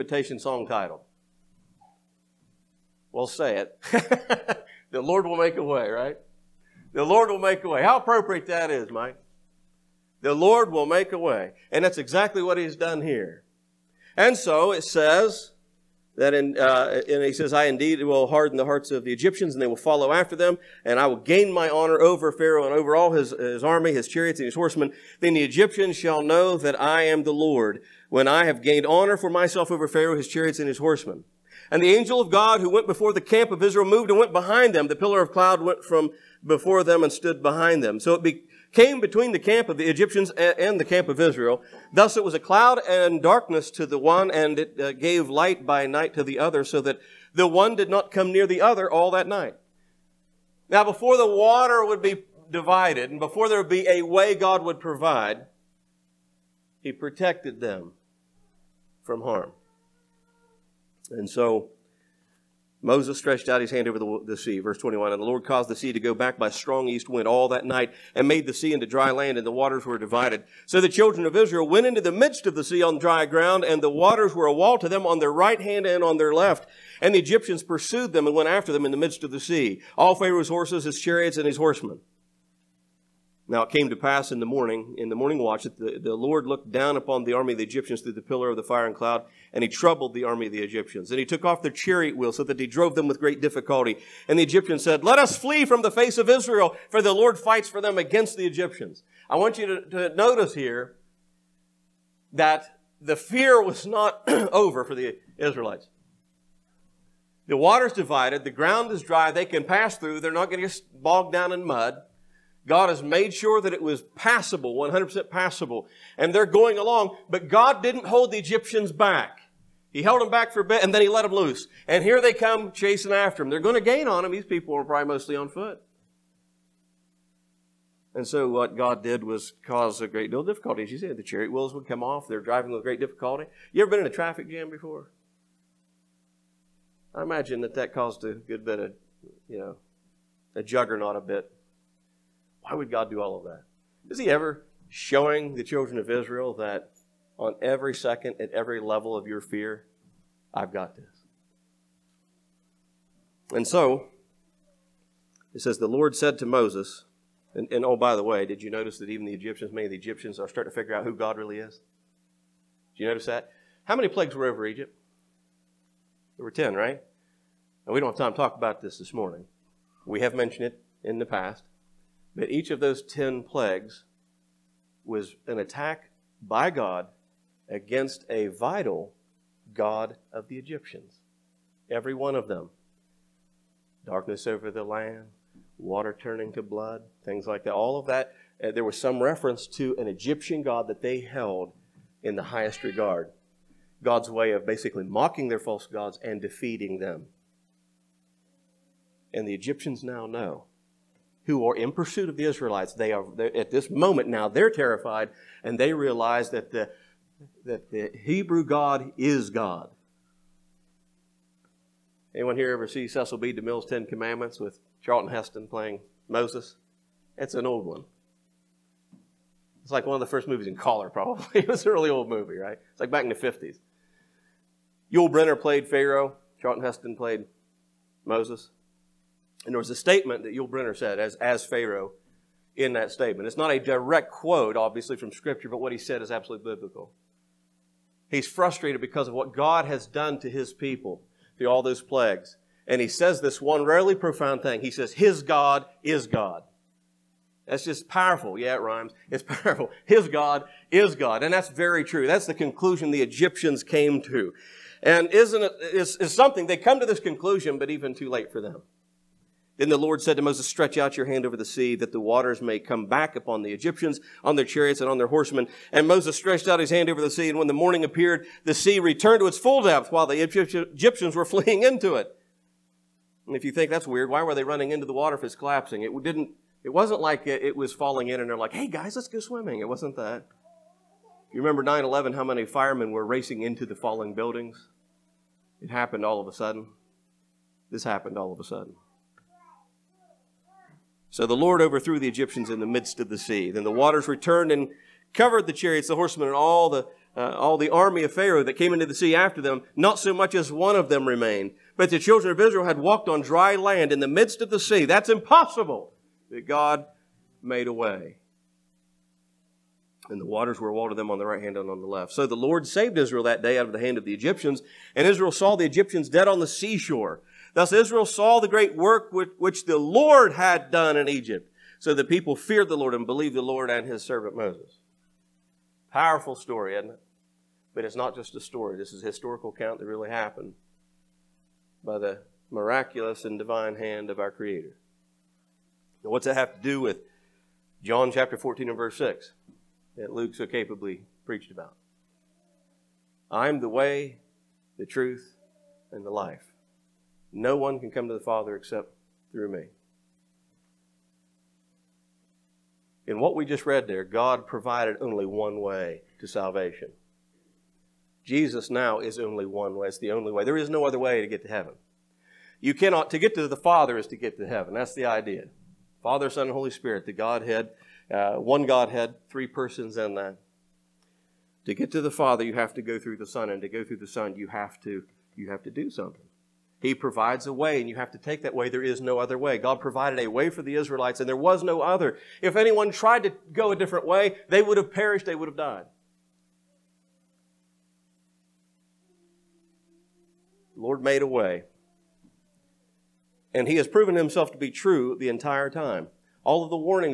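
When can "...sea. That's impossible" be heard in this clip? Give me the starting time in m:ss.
5:04.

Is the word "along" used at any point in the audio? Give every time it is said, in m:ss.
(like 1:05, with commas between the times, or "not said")
1:56.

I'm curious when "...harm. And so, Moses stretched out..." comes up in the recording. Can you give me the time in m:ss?
0:59.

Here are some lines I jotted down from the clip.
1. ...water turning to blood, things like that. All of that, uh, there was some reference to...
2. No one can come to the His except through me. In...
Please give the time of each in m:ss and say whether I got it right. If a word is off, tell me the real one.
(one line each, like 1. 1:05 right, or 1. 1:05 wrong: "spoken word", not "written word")
1. 3:05 right
2. 5:47 wrong: "Father", not "His".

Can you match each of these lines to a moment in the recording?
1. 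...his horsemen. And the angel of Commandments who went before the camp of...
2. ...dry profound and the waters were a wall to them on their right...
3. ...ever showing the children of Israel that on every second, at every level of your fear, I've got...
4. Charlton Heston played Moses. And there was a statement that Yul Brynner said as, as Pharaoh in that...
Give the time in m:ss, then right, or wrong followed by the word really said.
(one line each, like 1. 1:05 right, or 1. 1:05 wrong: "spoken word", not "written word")
1. 0:30 wrong: "God", not "Commandments"
2. 1:12 wrong: "ground", not "profound"
3. 2:24 right
4. 3:46 right.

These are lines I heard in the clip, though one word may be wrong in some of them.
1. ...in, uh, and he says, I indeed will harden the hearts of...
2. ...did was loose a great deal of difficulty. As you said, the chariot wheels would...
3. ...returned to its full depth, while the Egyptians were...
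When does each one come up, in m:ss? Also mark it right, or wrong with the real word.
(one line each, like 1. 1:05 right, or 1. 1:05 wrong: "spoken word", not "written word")
1. 0:16 right
2. 2:09 wrong: "cause", not "loose"
3. 4:28 right.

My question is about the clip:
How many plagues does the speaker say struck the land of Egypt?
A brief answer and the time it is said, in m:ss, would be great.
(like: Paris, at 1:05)
10, at 2:46.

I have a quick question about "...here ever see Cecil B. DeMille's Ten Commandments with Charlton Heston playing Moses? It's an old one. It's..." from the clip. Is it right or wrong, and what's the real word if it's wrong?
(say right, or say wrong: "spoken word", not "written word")
right.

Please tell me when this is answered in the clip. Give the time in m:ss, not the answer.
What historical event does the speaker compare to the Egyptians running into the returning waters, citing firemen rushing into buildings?
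4:41.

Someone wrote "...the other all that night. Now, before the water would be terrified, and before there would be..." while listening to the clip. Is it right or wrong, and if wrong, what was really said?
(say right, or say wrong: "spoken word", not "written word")
wrong: "divided", not "terrified".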